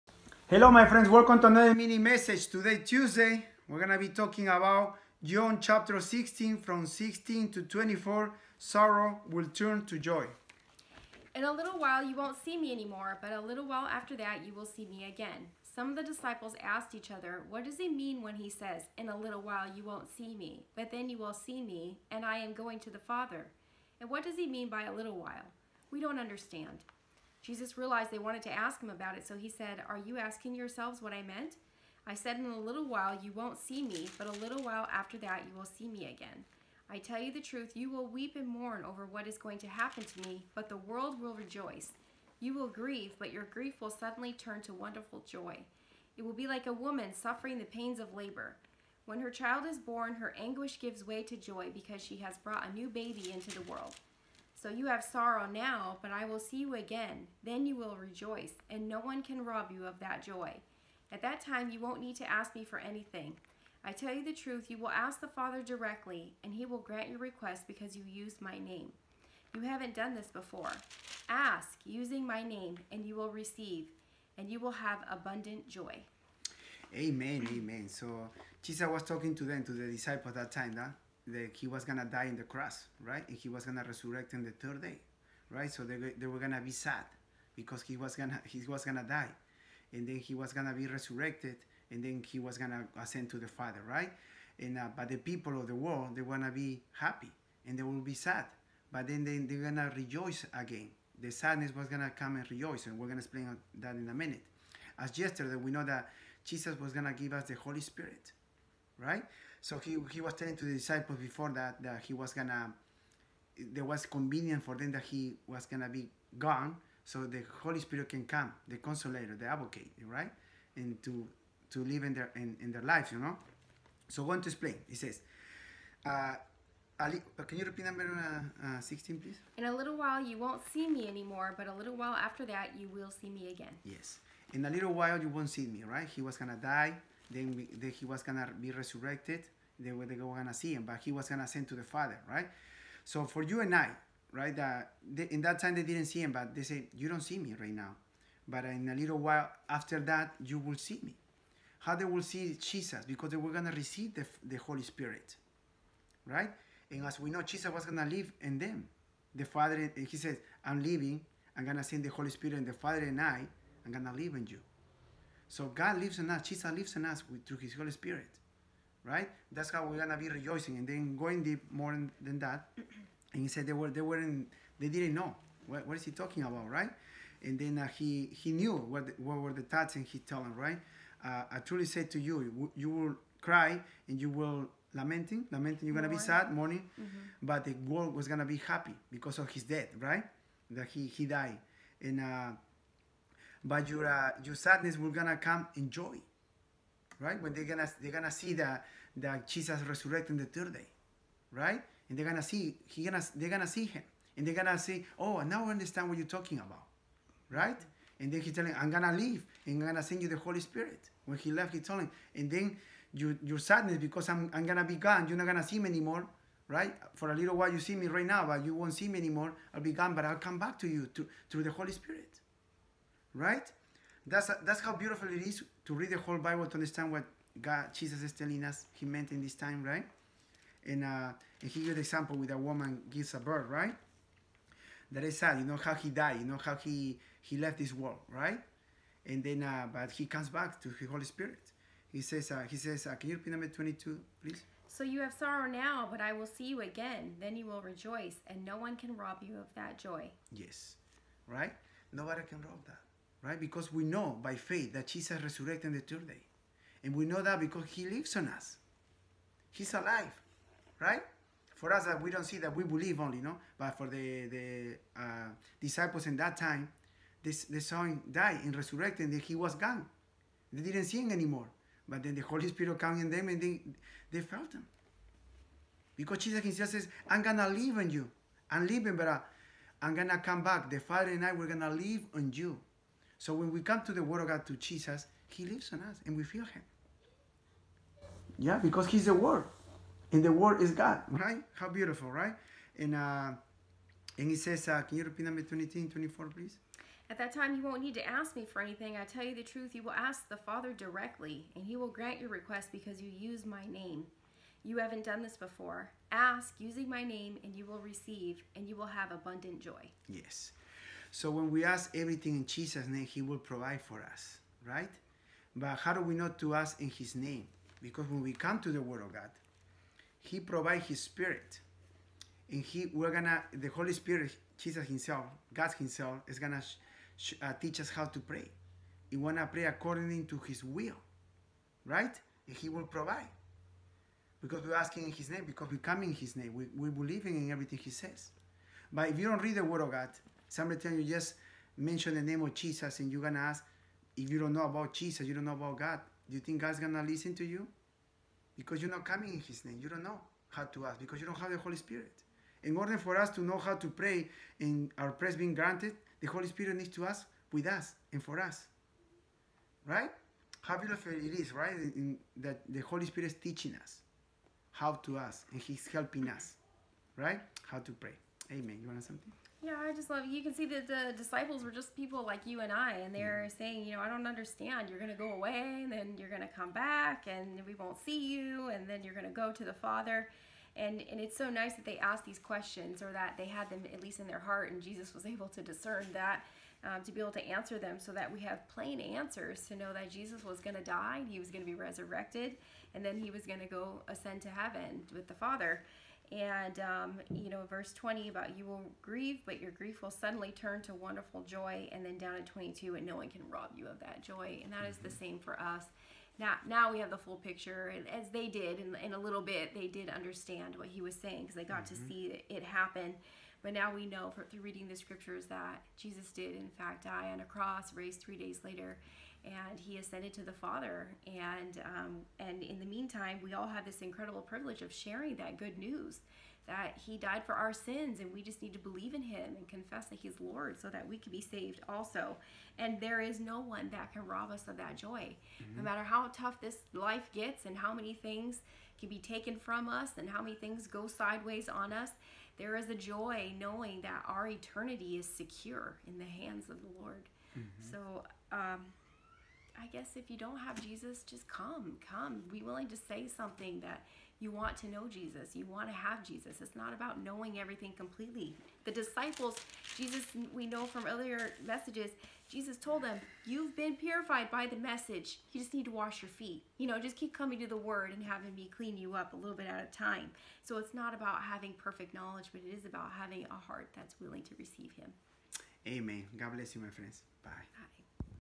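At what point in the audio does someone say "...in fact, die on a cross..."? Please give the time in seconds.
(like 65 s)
416 s.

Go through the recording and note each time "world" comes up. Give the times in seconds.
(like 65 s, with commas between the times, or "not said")
40 s, 53 s, 95 s, 187 s, 237 s.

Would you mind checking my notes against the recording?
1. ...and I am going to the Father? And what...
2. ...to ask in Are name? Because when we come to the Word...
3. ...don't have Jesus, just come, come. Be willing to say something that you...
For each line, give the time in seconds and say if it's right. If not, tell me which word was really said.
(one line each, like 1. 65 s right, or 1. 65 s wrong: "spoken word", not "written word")
1. 22 s right
2. 316 s wrong: "His", not "Are"
3. 450 s right.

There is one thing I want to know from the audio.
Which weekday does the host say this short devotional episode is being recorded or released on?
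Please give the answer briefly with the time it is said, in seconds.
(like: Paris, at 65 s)
Tuesday, at 2 s.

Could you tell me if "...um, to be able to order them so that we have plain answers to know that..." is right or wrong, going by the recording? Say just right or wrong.
wrong.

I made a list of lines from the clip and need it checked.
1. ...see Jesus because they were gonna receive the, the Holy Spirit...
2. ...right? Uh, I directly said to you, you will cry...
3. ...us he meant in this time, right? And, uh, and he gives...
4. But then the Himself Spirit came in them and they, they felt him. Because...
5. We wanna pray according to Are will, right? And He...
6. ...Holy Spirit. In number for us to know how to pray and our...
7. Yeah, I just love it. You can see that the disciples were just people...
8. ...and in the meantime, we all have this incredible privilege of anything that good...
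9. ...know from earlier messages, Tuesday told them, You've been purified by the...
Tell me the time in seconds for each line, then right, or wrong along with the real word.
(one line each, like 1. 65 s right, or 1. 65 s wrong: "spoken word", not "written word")
1. 152 s right
2. 180 s wrong: "truly", not "directly"
3. 228 s right
4. 272 s wrong: "Holy", not "Himself"
5. 329 s wrong: "His", not "Are"
6. 351 s wrong: "order", not "number"
7. 369 s right
8. 422 s wrong: "sharing", not "anything"
9. 460 s wrong: "Jesus", not "Tuesday".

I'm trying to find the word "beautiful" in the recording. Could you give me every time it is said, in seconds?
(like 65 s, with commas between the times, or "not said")
224 s, 291 s, 360 s.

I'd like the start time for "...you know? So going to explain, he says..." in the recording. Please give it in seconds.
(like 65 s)
123 s.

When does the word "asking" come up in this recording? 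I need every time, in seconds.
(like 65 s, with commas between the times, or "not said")
30 s, 334 s.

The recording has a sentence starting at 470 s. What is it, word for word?
So it's not about having perfect knowledge, but it is about having a heart that's willing to receive Him.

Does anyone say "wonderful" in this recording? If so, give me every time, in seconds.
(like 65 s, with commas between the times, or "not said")
44 s, 401 s.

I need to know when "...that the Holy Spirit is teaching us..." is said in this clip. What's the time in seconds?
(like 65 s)
362 s.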